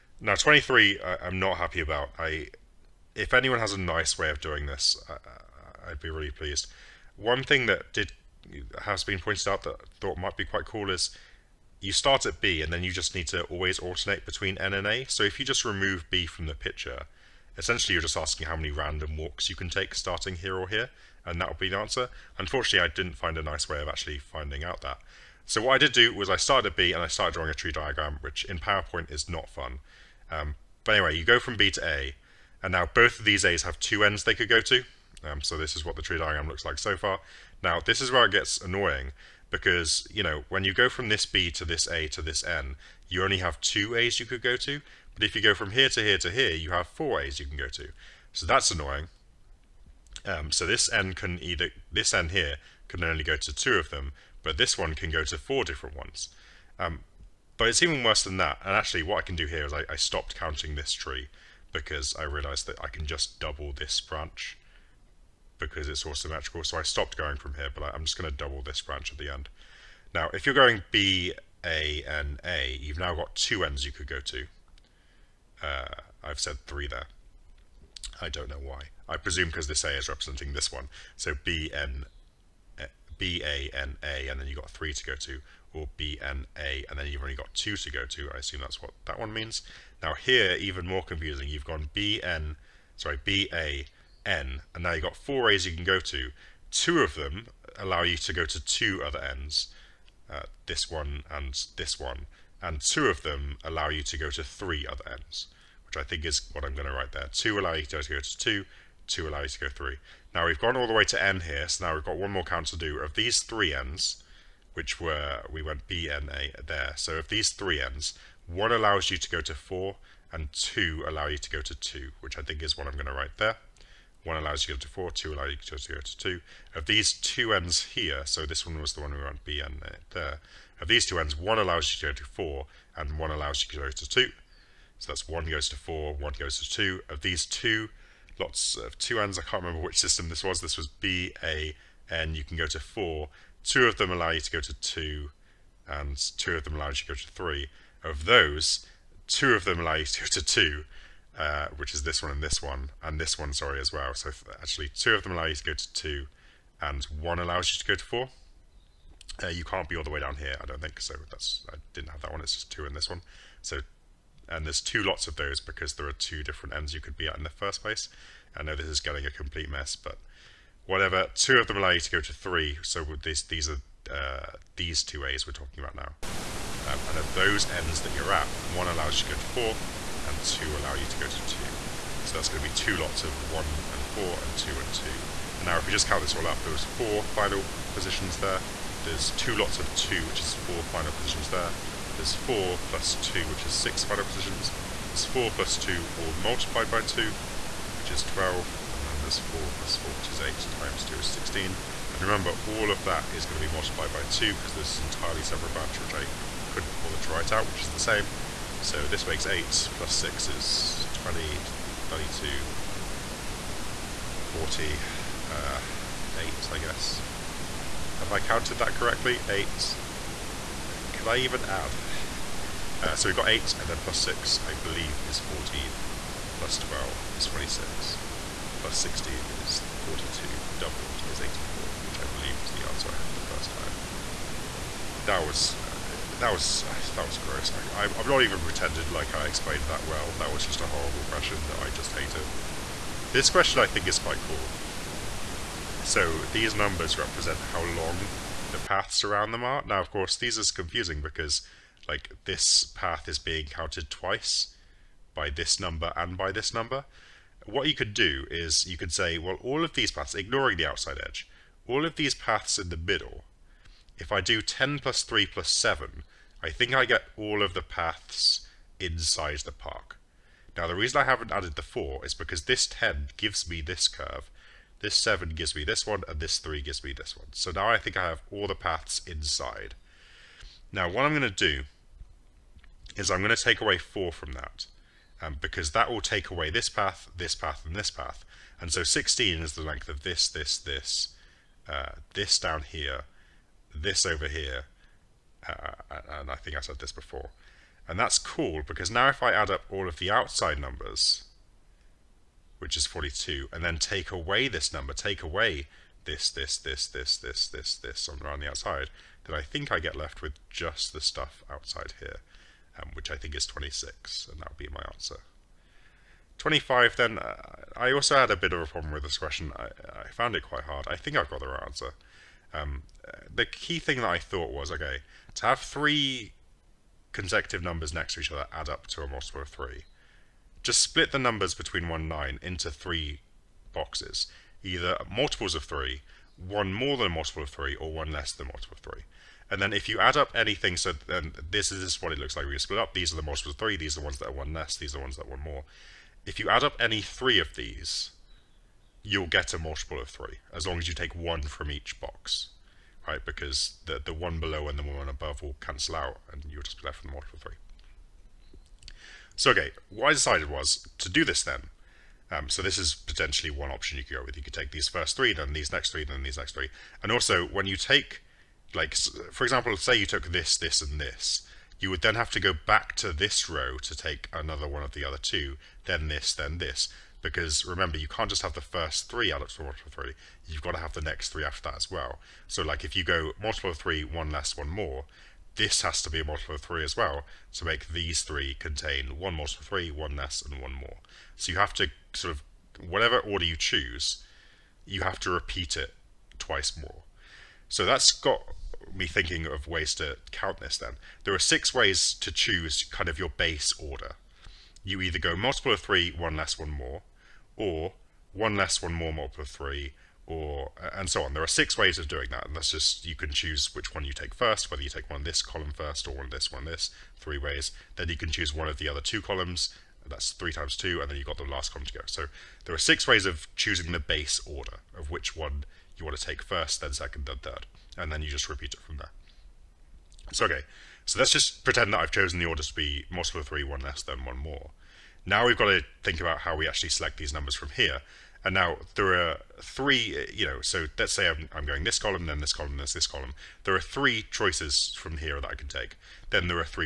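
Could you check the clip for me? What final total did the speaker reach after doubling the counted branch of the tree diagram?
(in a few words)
84.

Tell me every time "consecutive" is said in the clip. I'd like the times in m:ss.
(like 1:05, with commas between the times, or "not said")
5:27.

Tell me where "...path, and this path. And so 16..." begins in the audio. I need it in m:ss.
4:47.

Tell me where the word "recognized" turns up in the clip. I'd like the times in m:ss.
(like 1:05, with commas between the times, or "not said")
not said.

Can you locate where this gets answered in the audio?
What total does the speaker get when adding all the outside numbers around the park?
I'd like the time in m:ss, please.
5:02.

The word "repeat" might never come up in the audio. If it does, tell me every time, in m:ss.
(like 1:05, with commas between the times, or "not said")
6:35, 7:08.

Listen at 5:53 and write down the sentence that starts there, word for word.
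Because the the one below and the one above will cancel out, and you'll just be left with a multiple of three.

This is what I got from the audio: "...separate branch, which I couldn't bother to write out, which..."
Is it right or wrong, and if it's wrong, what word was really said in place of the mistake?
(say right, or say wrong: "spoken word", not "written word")
right.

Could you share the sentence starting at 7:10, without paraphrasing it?
So okay, so let's just pretend that I've chosen the order to be multiple of three, one less, then one more.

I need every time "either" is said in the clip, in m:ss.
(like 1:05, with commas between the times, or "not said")
0:51, 5:34, 6:45.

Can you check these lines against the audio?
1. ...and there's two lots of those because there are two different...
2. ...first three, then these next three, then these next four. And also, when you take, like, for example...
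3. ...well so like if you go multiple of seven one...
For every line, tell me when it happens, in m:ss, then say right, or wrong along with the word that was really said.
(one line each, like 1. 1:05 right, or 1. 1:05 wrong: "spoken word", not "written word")
1. 2:44 right
2. 6:05 wrong: "three", not "four"
3. 6:22 wrong: "three", not "seven".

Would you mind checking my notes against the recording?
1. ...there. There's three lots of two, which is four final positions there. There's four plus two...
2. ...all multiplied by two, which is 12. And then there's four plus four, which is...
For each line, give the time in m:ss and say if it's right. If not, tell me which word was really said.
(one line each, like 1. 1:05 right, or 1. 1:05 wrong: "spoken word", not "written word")
1. 3:08 wrong: "two", not "three"
2. 3:16 right.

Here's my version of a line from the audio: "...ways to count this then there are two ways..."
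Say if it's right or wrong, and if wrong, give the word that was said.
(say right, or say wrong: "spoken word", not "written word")
wrong: "six", not "two".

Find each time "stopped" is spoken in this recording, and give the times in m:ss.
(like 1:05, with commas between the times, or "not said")
0:59, 1:06.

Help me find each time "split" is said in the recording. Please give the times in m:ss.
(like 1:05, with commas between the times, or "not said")
5:31, 5:42.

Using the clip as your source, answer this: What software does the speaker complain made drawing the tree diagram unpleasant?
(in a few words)
PowerPoint.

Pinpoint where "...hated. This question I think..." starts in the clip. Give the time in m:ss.
4:02.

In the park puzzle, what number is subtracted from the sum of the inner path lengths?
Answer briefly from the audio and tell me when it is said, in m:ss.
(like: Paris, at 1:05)
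4, at 4:43.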